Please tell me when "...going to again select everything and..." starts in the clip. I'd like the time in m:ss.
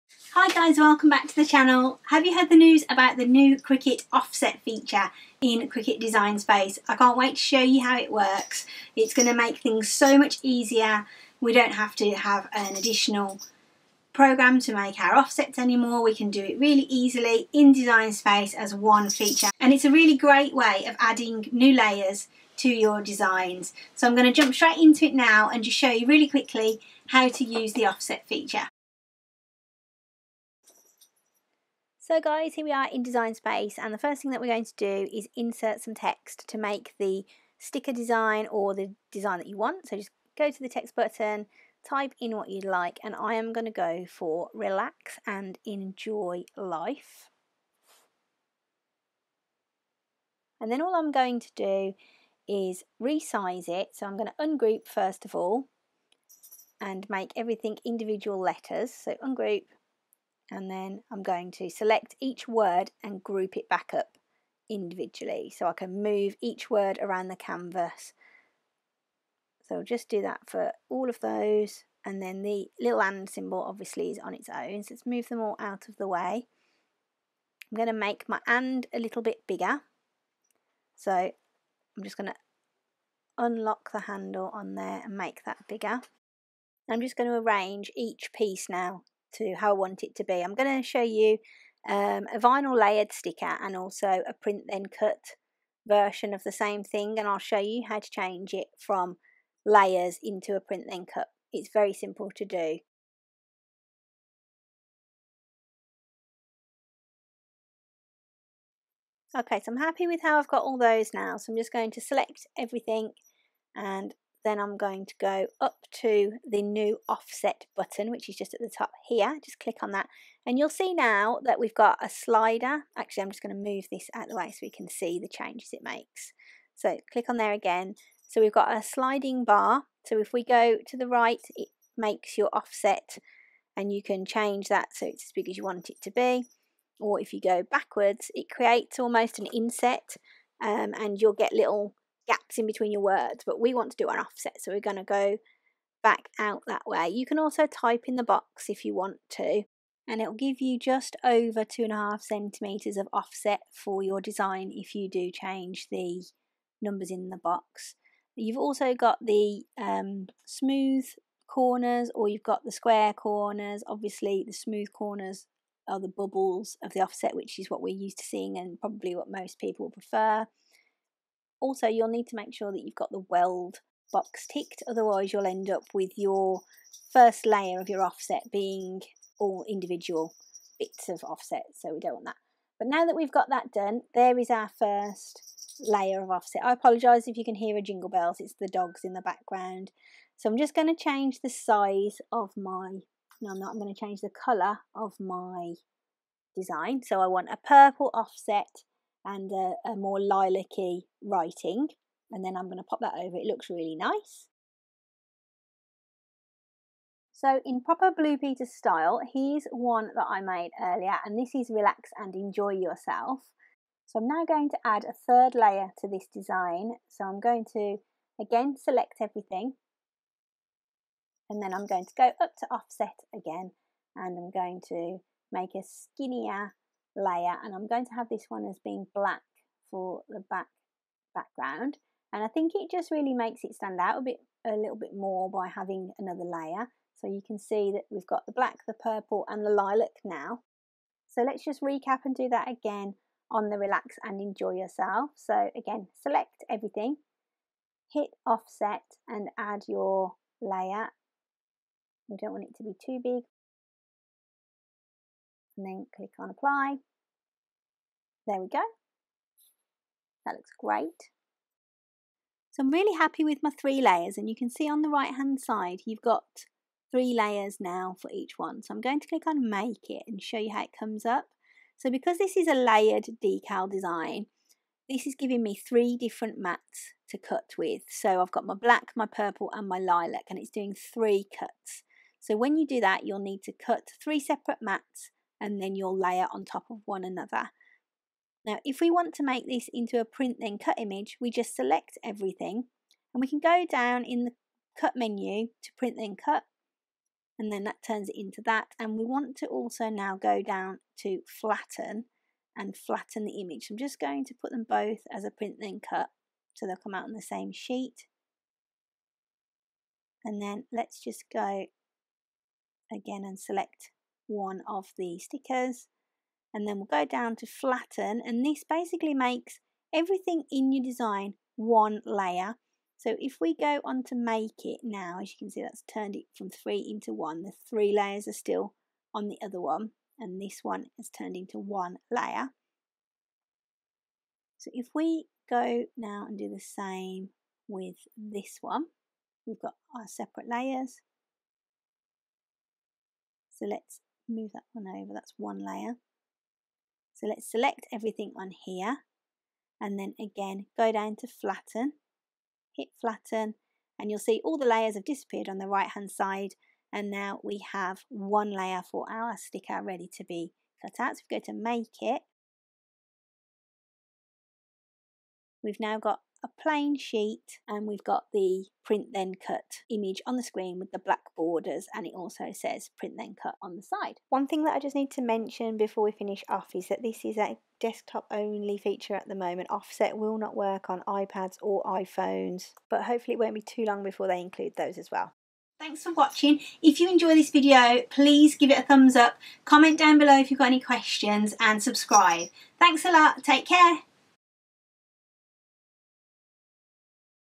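3:37.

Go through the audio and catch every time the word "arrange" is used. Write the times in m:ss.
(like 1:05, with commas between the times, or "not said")
1:27.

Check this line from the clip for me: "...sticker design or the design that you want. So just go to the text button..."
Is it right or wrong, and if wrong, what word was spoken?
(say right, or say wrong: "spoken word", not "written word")
right.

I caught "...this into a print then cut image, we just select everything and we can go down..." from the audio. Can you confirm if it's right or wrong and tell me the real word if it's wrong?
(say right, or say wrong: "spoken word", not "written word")
right.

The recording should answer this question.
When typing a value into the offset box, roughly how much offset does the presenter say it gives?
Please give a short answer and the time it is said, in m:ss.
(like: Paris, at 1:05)
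just over 2.5 centimetres, at 2:30.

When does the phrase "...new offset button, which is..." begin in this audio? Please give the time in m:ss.
1:56.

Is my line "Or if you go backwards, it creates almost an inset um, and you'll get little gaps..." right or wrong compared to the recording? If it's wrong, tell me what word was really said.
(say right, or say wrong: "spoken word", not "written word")
right.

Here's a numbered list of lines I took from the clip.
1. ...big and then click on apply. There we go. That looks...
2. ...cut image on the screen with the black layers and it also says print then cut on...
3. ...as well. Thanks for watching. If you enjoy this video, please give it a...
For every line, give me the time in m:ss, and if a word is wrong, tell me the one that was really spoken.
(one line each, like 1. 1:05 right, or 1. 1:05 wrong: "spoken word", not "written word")
1. 4:13 right
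2. 6:09 wrong: "borders", not "layers"
3. 6:25 right.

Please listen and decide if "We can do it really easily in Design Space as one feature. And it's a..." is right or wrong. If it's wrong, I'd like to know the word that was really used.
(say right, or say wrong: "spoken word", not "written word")
right.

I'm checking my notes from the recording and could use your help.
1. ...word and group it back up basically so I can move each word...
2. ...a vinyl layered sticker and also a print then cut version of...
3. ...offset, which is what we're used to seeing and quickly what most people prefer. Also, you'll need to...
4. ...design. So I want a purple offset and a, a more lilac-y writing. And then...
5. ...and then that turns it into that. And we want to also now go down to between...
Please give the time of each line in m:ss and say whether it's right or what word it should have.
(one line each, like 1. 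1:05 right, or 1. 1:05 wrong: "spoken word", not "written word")
1. 1:02 wrong: "individually", not "basically"
2. 1:32 right
3. 2:47 wrong: "probably", not "quickly"
4. 3:16 right
5. 4:57 wrong: "flatten", not "between".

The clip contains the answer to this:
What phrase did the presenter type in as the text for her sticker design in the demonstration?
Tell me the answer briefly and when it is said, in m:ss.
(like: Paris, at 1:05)
relax and enjoy life, at 0:44.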